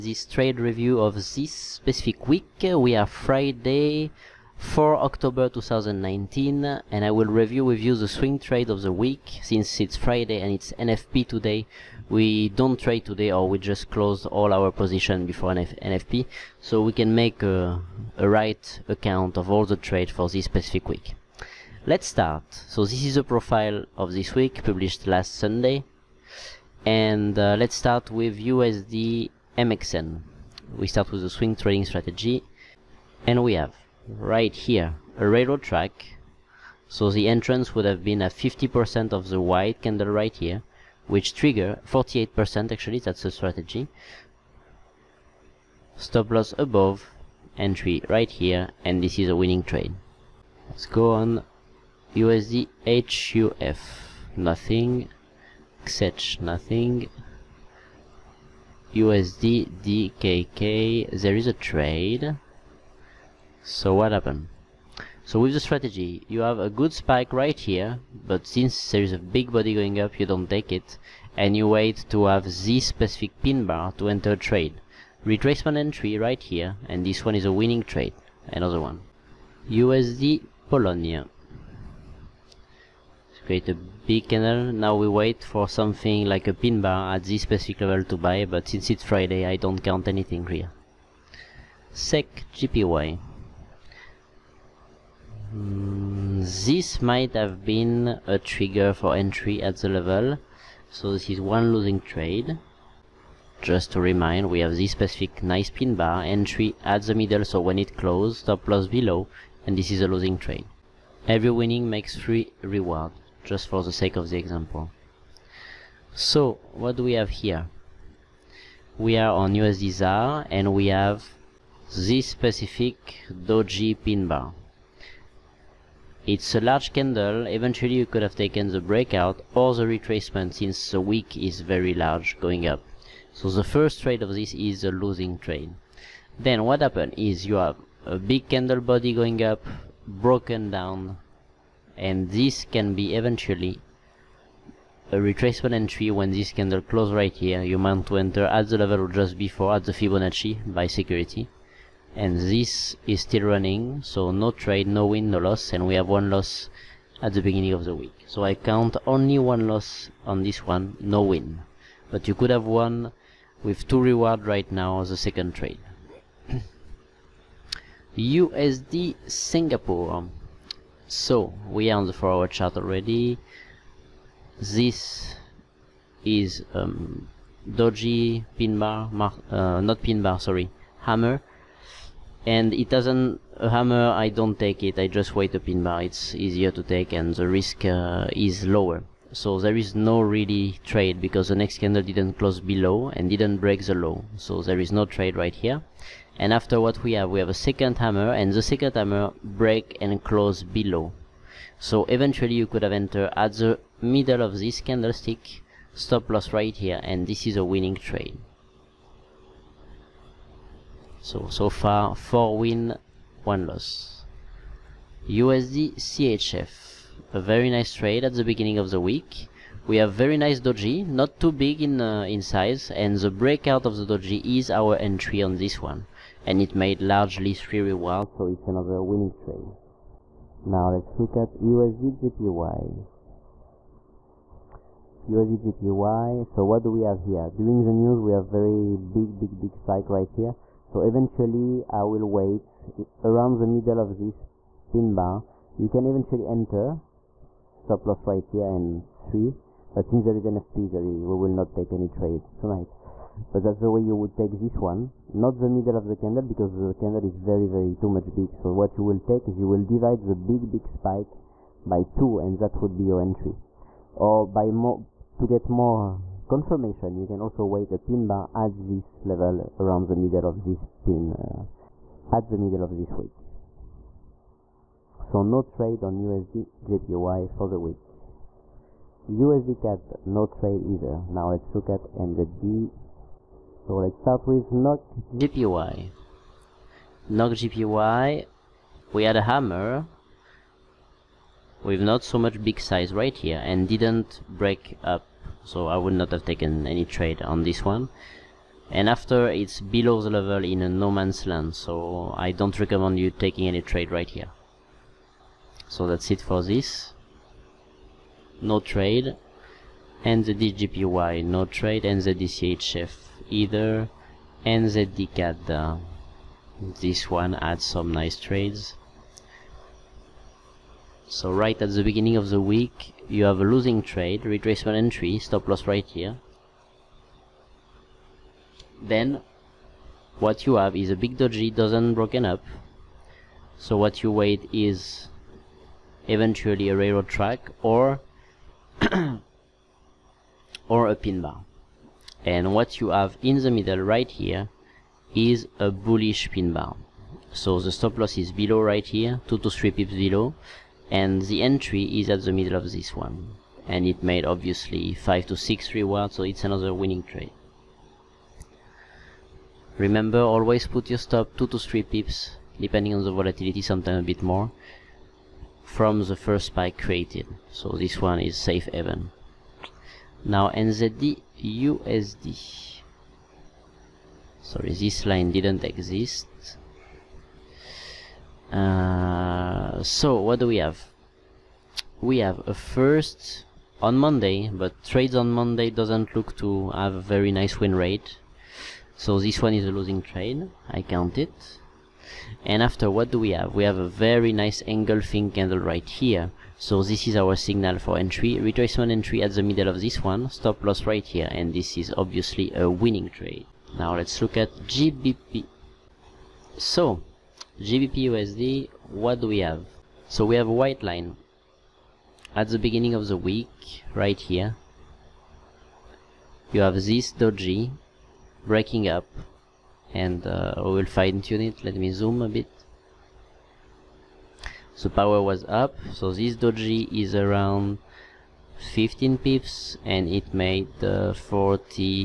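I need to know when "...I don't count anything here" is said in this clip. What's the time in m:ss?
1:29.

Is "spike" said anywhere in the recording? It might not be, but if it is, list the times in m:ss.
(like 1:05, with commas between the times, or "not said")
1:06, 3:59, 4:20, 6:06.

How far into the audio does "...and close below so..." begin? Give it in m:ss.
3:20.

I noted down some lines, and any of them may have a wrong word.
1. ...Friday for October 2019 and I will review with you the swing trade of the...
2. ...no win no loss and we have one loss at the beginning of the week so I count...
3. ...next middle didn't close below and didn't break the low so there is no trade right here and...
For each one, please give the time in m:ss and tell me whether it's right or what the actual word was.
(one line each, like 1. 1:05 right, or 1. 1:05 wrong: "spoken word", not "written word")
1. 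0:03 right
2. 2:34 right
3. 3:11 wrong: "candle", not "middle".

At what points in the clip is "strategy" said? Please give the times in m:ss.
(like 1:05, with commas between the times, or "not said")
0:31, 0:43, 1:05.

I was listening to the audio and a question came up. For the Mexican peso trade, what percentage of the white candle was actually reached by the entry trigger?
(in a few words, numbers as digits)
48%.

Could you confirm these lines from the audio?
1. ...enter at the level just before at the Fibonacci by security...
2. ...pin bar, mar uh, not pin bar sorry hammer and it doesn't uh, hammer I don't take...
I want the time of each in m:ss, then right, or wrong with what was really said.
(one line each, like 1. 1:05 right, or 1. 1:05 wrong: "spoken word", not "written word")
1. 2:28 right
2. 2:58 right.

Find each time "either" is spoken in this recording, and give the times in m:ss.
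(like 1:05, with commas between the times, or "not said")
4:40, 5:13.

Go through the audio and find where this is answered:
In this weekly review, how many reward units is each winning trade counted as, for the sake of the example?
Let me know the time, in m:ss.
1:52.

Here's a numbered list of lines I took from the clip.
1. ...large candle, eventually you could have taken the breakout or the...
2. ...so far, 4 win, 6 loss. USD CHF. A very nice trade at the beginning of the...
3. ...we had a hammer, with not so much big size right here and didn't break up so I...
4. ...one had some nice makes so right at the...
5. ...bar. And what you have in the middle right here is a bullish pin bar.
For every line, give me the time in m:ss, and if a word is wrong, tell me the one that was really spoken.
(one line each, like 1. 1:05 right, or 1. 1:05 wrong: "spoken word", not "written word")
1. 2:06 right
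2. 3:31 wrong: "1", not "6"
3. 4:49 right
4. 5:17 wrong: "trades", not "makes"
5. 5:41 right.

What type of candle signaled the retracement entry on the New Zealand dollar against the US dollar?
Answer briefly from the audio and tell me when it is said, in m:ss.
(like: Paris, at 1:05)
Engulfing candle, at 6:34.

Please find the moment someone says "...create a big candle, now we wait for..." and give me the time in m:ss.
1:23.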